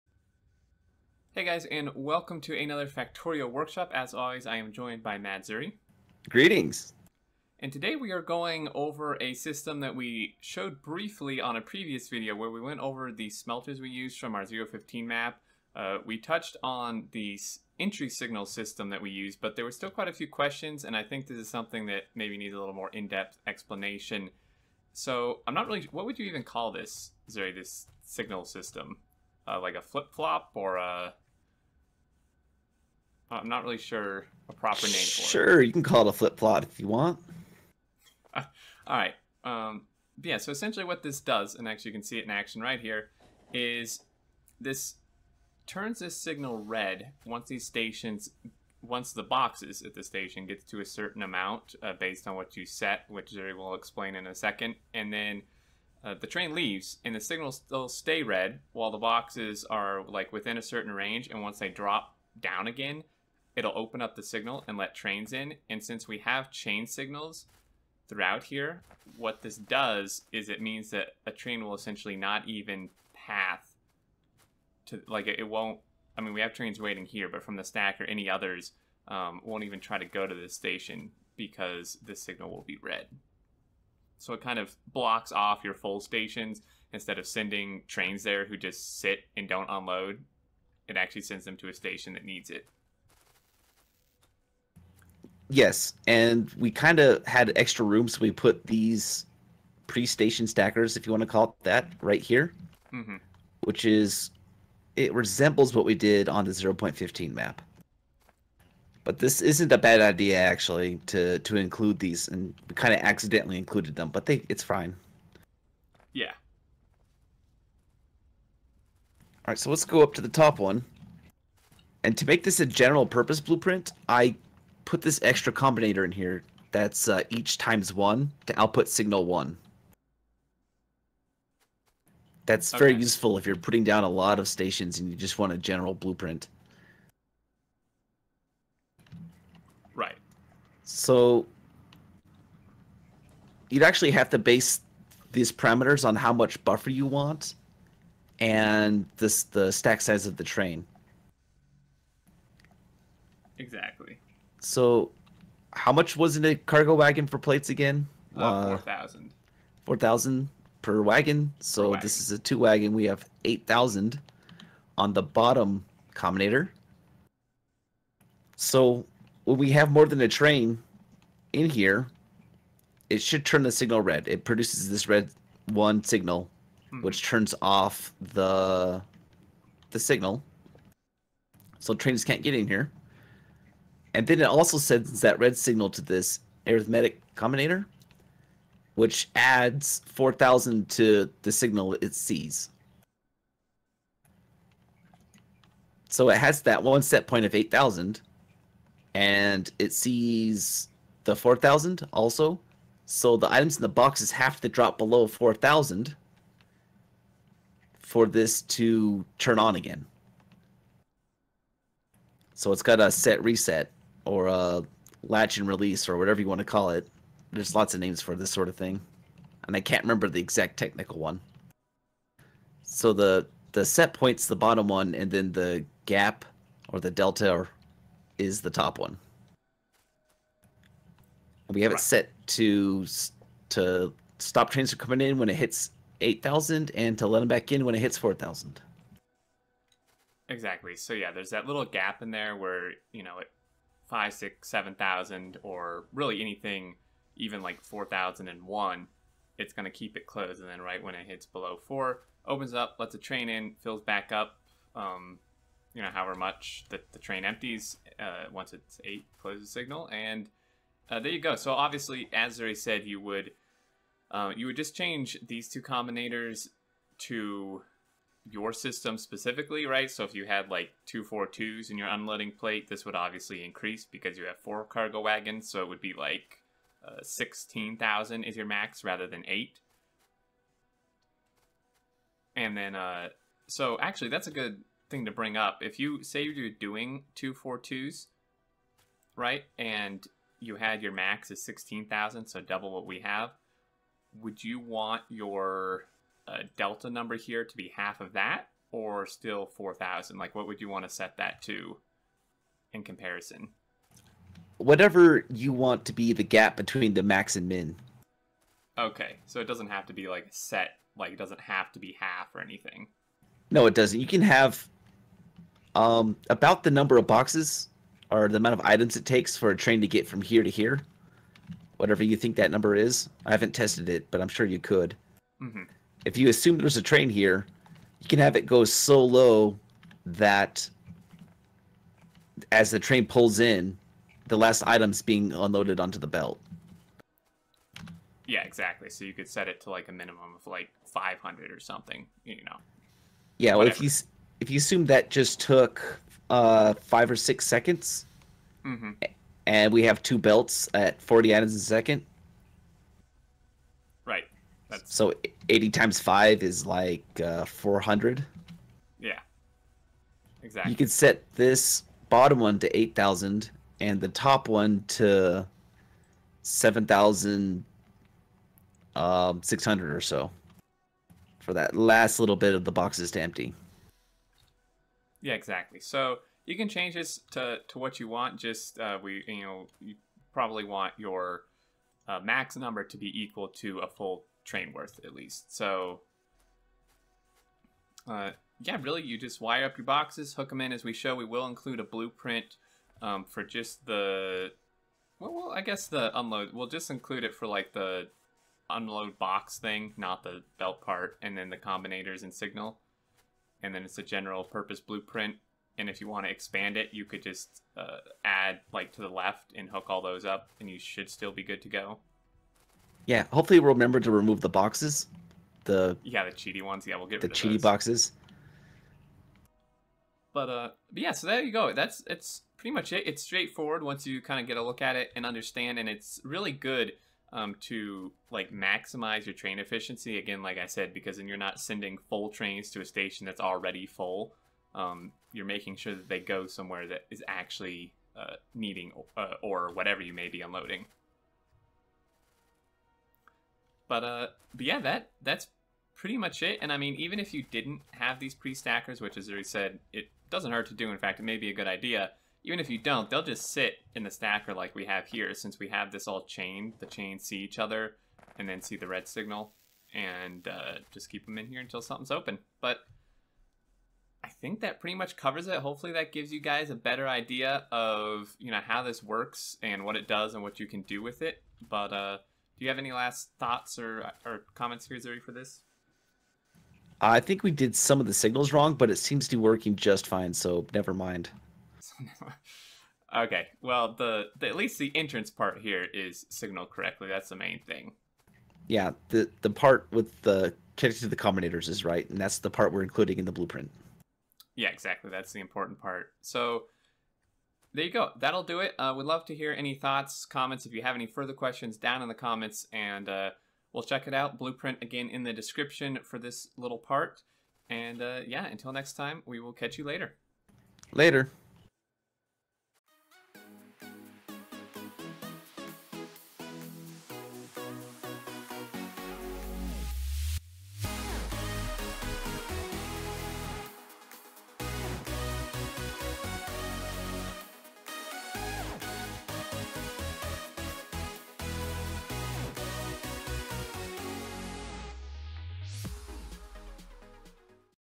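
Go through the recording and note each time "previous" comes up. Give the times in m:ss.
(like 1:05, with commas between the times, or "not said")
0:11.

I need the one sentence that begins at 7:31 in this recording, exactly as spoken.
In fact, it may be a good idea.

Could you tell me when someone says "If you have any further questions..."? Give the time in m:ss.
8:20.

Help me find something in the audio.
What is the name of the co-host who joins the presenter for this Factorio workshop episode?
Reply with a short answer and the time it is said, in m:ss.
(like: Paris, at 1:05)
Madzuri, at 0:05.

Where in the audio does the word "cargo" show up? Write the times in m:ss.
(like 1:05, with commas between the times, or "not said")
2:36, 4:34.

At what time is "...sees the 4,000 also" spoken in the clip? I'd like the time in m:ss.
3:19.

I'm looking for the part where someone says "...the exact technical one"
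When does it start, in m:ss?
3:40.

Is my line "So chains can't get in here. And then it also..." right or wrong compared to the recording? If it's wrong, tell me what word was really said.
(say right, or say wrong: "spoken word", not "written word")
wrong: "trains", not "chains".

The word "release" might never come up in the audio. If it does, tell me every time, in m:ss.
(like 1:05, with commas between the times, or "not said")
3:35.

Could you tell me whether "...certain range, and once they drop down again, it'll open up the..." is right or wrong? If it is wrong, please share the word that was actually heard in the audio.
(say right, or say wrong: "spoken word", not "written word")
right.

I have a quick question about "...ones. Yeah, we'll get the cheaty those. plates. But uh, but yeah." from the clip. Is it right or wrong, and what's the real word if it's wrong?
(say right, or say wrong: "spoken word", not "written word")
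wrong: "boxes", not "plates".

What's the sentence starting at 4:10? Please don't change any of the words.
And then right when it hits below four, opens up, lets the train in, fills back up.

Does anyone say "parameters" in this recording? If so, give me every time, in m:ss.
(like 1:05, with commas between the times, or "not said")
2:25.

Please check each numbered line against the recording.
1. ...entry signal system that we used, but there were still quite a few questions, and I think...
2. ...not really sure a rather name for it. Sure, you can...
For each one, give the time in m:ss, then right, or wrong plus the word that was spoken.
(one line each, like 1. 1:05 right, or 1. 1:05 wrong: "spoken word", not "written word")
1. 0:17 right
2. 0:33 wrong: "proper", not "rather".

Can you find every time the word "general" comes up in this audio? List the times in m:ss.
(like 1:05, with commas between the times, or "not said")
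2:02, 2:15, 6:44.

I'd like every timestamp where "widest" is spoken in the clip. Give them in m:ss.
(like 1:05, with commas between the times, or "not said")
not said.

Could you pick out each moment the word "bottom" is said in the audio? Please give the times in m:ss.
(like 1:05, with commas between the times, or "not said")
2:45, 3:44, 6:02.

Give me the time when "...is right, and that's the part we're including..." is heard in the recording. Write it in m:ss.
8:11.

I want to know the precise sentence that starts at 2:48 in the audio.
So when we have more than a train in here, it should turn the signal red.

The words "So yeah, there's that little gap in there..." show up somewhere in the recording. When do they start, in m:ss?
4:00.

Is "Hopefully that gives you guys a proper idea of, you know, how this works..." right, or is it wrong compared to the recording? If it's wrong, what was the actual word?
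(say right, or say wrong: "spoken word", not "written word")
wrong: "better", not "proper".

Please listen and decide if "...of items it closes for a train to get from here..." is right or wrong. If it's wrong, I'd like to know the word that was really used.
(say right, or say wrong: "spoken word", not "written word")
wrong: "takes", not "closes".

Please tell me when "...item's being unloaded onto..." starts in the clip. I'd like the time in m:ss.
5:34.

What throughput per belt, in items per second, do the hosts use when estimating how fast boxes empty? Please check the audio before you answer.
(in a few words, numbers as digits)
40.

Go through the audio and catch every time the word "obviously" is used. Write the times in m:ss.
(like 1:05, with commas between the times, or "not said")
4:21, 4:33.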